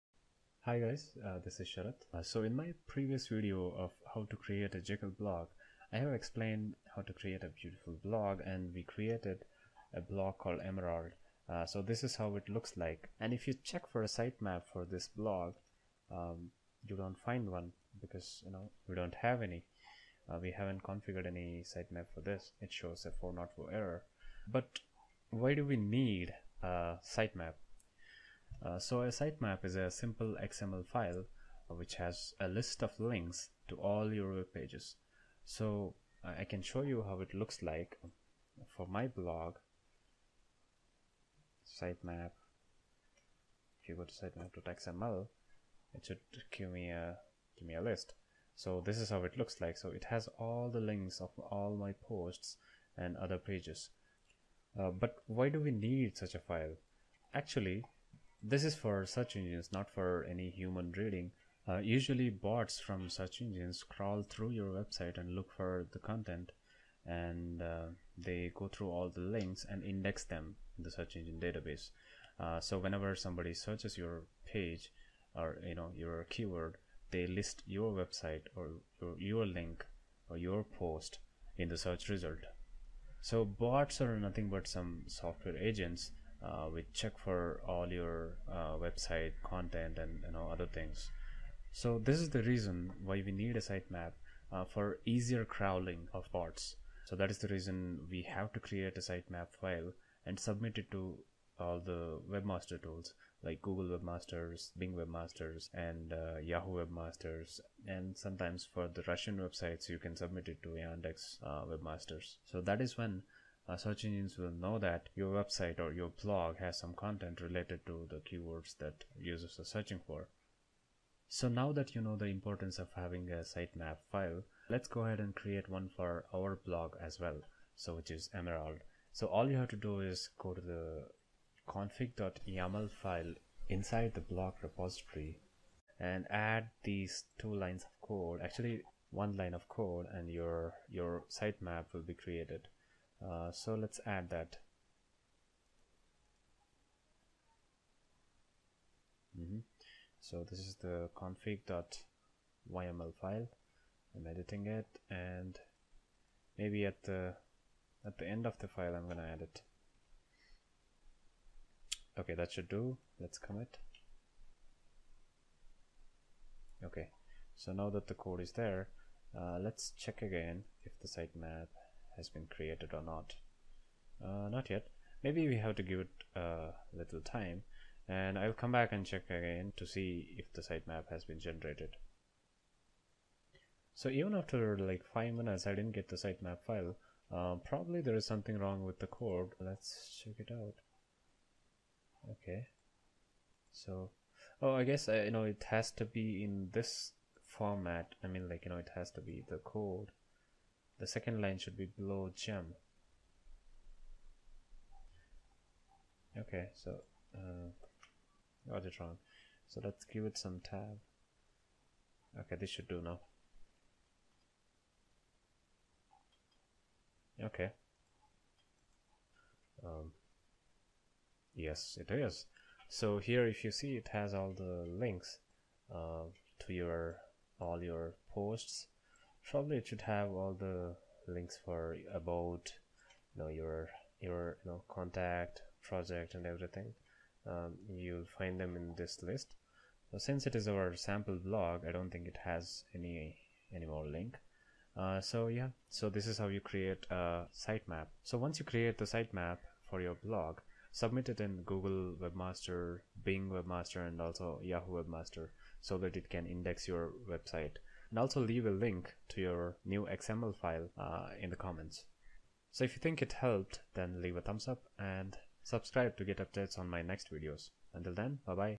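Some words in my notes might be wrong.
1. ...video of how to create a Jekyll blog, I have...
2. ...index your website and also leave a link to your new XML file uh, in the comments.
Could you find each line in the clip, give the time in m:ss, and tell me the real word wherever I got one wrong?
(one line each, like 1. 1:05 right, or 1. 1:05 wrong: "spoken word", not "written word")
1. 0:03 right
2. 4:16 right.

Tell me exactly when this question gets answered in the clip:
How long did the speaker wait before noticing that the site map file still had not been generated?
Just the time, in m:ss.
3:05.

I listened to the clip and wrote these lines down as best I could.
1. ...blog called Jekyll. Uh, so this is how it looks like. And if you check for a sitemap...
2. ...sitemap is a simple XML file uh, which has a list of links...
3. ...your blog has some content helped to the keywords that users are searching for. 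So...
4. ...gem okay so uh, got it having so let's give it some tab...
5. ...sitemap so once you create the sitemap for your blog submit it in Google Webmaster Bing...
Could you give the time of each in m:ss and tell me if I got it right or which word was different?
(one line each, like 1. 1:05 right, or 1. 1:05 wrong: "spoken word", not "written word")
1. 0:10 wrong: "Emerald", not "Jekyll"
2. 0:29 right
3. 1:55 wrong: "related", not "helped"
4. 3:22 wrong: "wrong", not "having"
5. 4:07 right.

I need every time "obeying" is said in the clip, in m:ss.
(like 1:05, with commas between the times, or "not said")
not said.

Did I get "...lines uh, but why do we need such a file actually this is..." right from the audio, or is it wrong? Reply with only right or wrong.
wrong.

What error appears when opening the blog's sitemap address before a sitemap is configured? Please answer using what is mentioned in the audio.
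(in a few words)
404 error.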